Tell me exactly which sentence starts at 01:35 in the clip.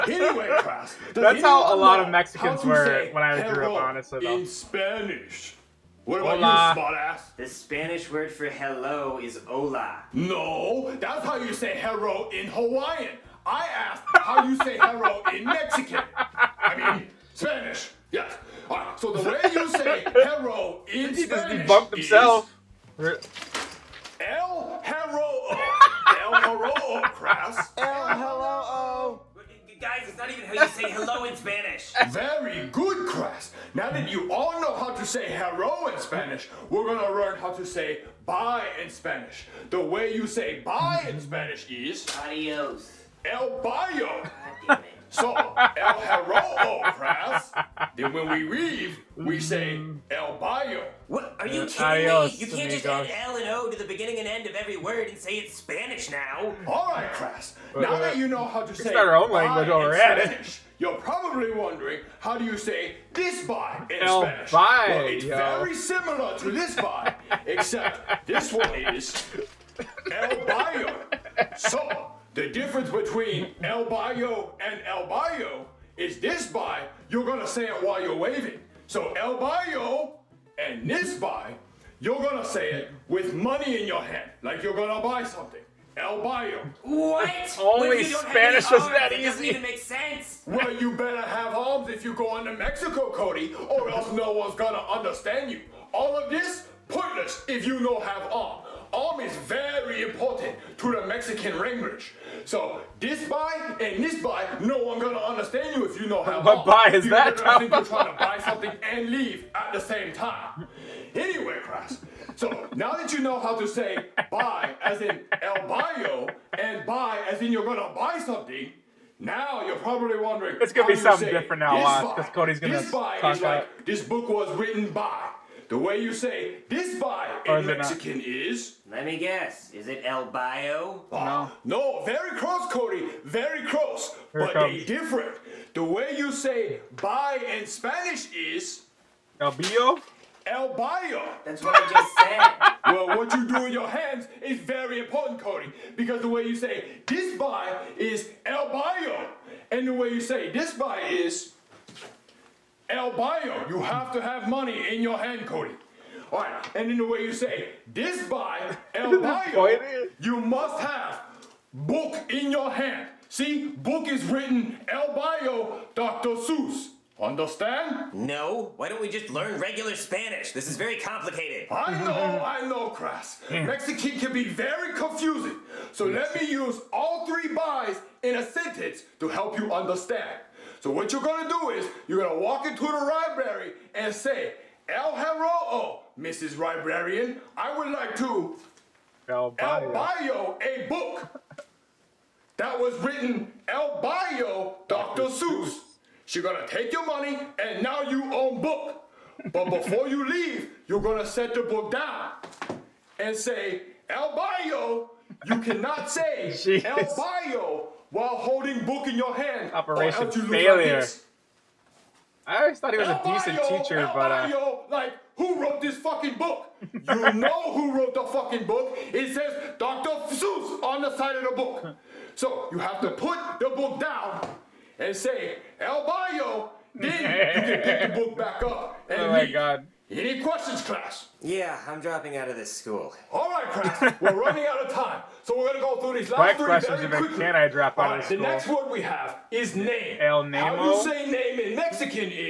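All of this pointless if you don't have arms.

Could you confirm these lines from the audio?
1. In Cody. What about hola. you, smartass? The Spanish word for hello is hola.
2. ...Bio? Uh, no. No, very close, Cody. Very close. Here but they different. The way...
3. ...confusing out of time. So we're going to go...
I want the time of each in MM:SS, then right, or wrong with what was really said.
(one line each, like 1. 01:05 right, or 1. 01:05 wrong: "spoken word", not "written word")
1. 00:04 wrong: "Spanish", not "Cody"
2. 02:10 right
3. 03:54 wrong: "running", not "confusing".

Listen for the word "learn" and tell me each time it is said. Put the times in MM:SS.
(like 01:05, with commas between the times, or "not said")
00:37, 02:49.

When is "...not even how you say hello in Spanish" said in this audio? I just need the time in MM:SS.
00:30.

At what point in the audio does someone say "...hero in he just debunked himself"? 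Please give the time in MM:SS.
00:20.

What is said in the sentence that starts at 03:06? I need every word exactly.
Librarian, I would like to El Bayo, El Bayo a book that was written El Bayo, Dr.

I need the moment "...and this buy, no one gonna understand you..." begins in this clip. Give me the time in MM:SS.
01:43.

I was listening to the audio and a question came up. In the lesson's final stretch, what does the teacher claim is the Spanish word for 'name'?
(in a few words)
El Nemo.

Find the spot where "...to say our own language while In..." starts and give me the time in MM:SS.
00:58.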